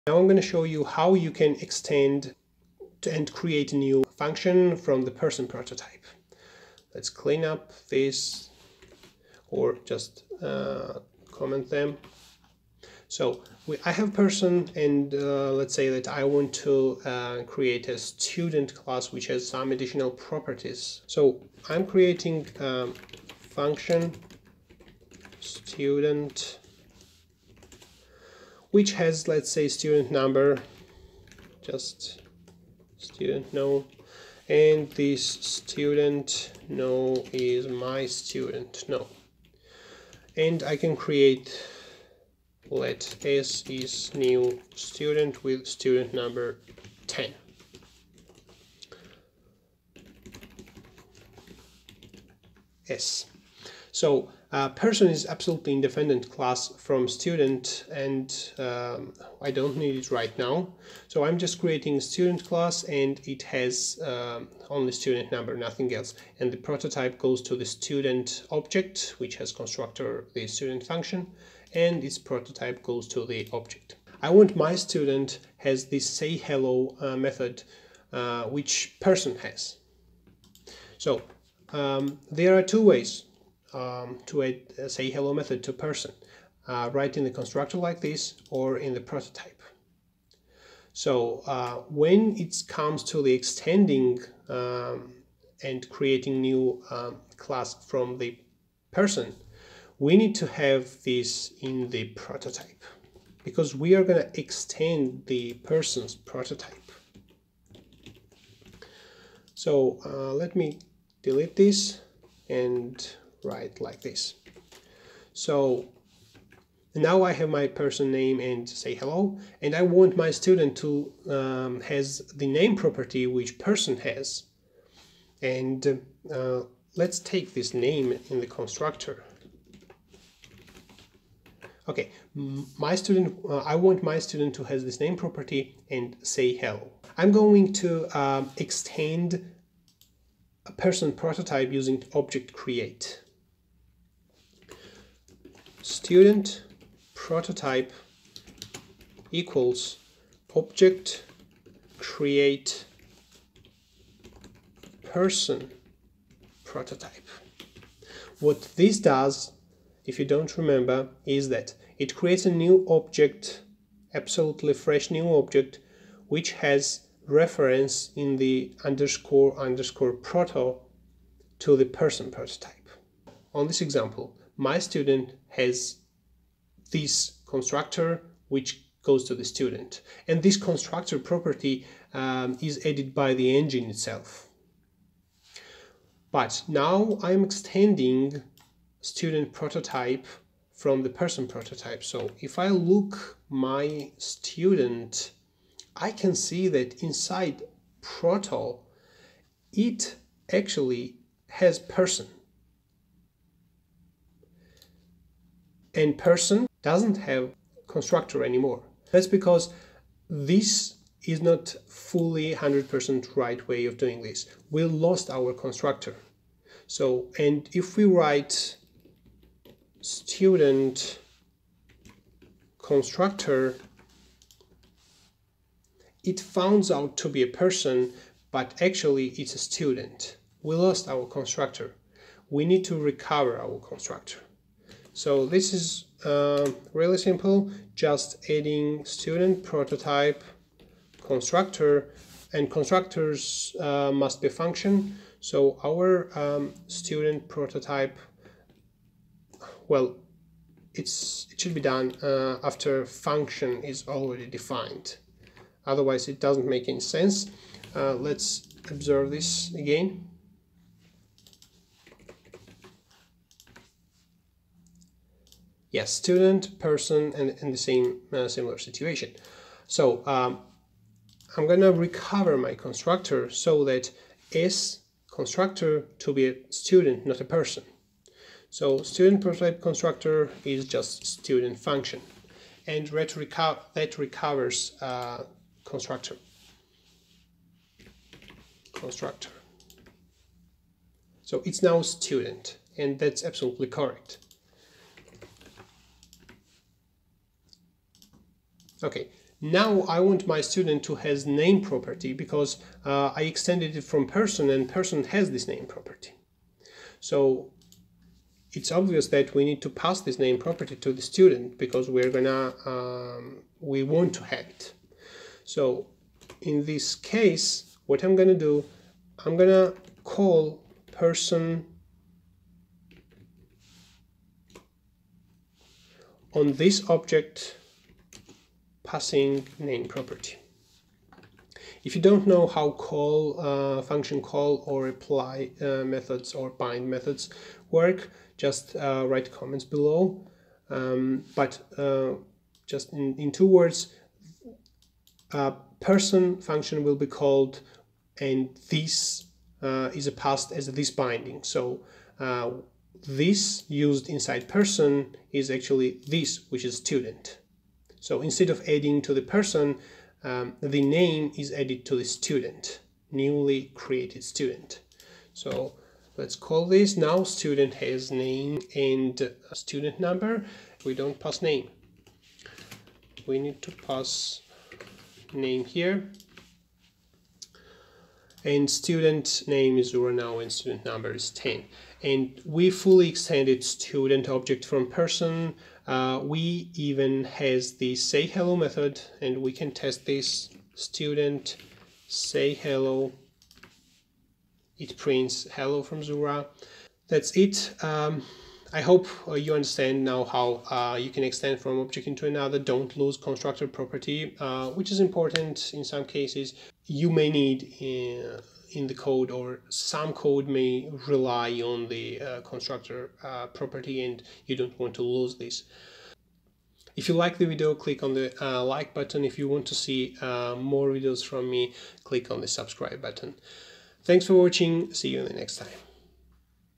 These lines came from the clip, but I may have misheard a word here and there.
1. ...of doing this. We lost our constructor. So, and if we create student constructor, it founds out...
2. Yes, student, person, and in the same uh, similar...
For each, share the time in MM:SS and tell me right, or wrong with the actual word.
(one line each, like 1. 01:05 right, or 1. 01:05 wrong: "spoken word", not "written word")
1. 03:33 wrong: "write", not "create"
2. 04:25 right.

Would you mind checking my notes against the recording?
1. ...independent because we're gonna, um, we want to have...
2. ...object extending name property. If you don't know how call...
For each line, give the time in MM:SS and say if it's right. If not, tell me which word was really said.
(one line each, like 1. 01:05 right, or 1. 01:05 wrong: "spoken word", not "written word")
1. 05:11 wrong: "student", not "independent"
2. 05:27 wrong: "passing", not "extending".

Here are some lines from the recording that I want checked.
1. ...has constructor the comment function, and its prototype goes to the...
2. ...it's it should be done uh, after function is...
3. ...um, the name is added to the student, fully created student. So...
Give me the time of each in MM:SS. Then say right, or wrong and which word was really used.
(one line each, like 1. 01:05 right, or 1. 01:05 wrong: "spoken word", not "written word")
1. 01:09 wrong: "student", not "comment"
2. 04:10 right
3. 06:00 wrong: "newly", not "fully".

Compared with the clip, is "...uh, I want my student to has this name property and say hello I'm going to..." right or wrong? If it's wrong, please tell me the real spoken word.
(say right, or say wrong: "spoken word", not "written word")
right.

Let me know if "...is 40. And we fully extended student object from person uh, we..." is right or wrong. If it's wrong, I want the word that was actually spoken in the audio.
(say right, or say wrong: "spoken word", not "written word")
wrong: "10", not "40".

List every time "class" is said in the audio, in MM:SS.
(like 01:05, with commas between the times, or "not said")
00:18, 00:56, 01:02, 01:37.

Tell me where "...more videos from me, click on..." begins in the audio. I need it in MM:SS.
07:00.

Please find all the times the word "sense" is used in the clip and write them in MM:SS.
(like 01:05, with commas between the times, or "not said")
04:16.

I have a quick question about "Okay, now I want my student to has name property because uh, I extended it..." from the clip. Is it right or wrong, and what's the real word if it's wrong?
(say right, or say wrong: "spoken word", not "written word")
right.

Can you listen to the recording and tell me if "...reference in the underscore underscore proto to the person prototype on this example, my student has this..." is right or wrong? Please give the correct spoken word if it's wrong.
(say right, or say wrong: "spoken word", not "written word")
right.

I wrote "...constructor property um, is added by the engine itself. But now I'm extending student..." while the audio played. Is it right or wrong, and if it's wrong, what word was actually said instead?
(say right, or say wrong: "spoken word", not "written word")
right.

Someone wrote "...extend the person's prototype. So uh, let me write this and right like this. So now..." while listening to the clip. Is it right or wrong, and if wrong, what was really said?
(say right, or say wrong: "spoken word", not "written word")
wrong: "delete", not "write".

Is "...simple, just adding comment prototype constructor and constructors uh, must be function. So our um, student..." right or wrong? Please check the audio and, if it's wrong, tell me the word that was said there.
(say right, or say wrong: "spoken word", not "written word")
wrong: "student", not "comment".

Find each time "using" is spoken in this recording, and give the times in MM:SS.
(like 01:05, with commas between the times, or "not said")
02:21.